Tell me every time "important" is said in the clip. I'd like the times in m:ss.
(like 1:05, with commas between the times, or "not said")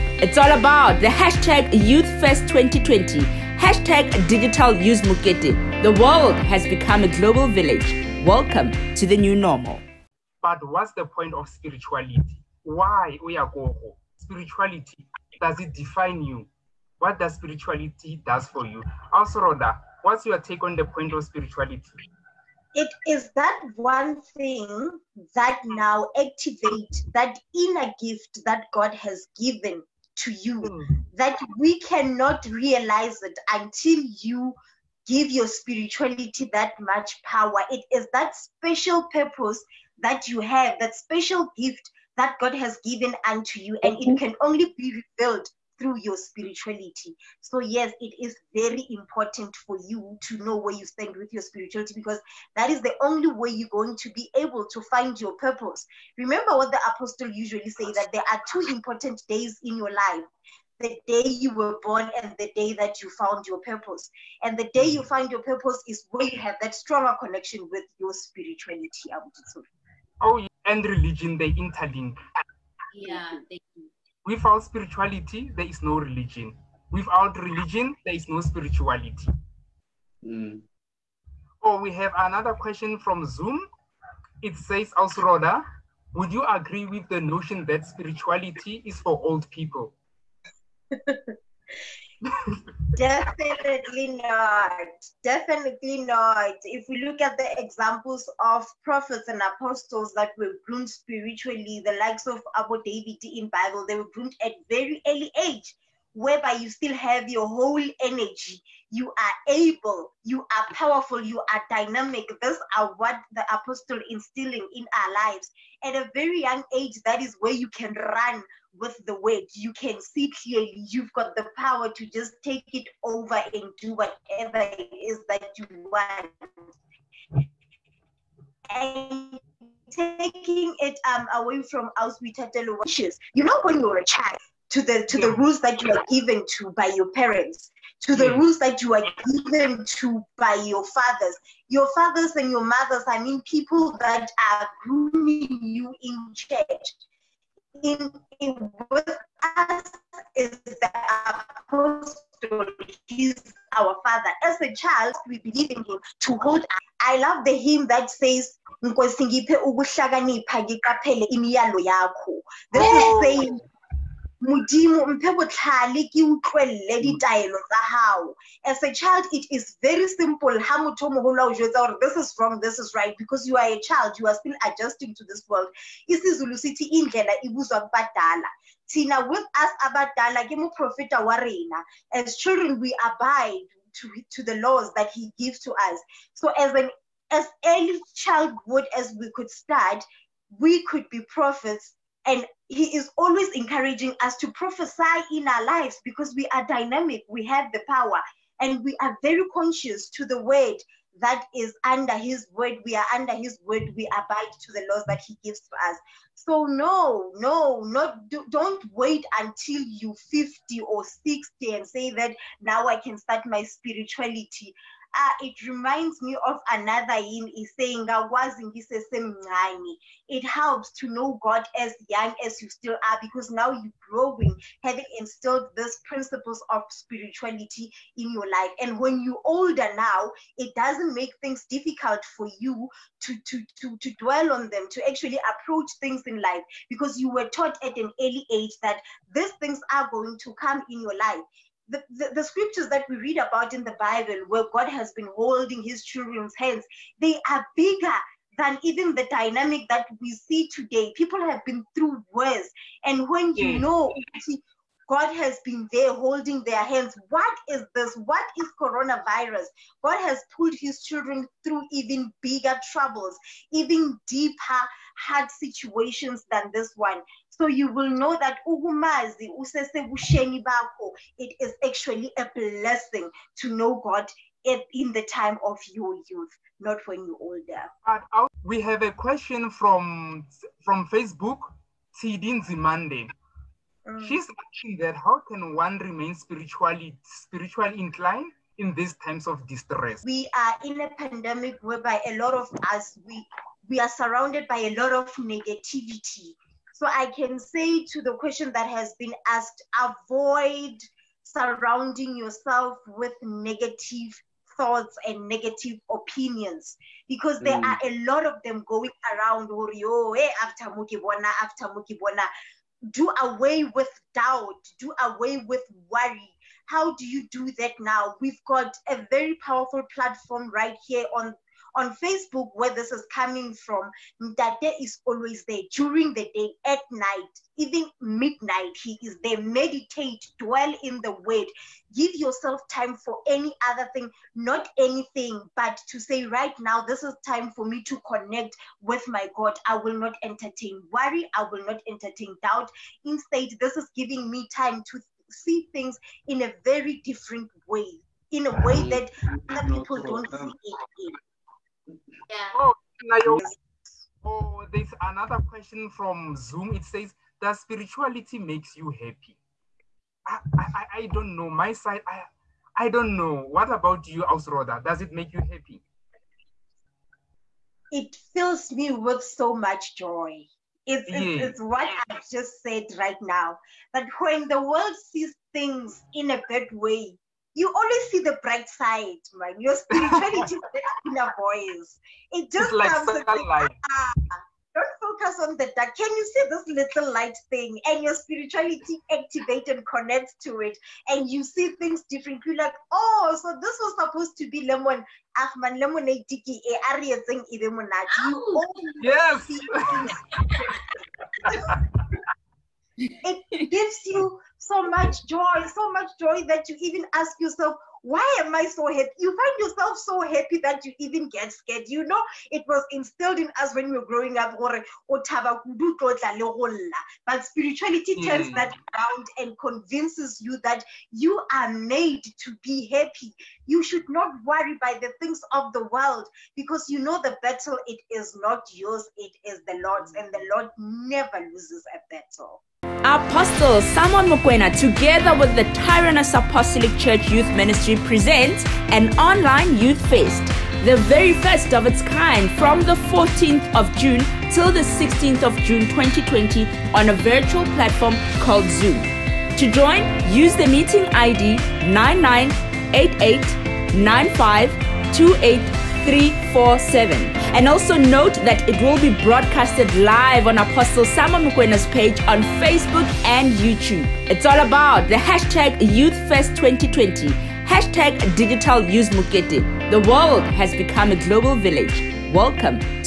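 0:48, 0:58.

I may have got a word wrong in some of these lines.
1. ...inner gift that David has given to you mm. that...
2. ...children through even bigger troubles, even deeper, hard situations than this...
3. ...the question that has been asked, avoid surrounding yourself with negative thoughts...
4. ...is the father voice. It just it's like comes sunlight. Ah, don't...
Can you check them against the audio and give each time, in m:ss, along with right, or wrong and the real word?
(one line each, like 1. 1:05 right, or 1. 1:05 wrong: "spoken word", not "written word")
1. 0:27 wrong: "God", not "David"
2. 4:21 right
3. 4:58 right
4. 6:20 wrong: "inner", not "father".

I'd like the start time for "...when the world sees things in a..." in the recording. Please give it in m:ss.
6:14.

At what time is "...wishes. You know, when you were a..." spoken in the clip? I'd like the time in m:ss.
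2:12.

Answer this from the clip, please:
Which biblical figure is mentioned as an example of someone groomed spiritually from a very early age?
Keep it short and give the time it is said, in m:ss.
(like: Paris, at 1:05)
David, at 1:42.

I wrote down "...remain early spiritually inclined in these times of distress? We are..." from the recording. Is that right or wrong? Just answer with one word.
wrong.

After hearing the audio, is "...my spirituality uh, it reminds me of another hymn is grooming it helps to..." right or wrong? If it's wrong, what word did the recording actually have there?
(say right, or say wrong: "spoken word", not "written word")
wrong: "saying", not "grooming".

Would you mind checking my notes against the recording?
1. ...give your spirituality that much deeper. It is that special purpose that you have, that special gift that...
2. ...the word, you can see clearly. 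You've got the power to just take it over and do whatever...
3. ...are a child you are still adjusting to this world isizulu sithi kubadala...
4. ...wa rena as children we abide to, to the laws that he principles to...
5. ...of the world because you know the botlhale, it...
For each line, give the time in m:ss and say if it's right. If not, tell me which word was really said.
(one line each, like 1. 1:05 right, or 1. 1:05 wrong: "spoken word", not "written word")
1. 0:35 wrong: "power", not "deeper"
2. 1:59 right
3. 2:53 wrong: "indlela", not "kubadala"
4. 3:01 wrong: "gives", not "principles"
5. 7:05 wrong: "battle", not "botlhale".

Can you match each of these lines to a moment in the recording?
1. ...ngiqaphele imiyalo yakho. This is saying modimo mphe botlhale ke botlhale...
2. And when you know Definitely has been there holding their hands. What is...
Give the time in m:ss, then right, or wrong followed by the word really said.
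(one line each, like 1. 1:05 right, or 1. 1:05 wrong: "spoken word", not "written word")
1. 2:40 wrong: "utlwelele", not "botlhale"
2. 4:13 wrong: "God", not "Definitely".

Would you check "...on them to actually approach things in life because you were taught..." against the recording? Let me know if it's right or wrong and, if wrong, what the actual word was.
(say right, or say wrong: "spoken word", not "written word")
right.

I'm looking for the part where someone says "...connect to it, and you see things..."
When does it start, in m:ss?
6:30.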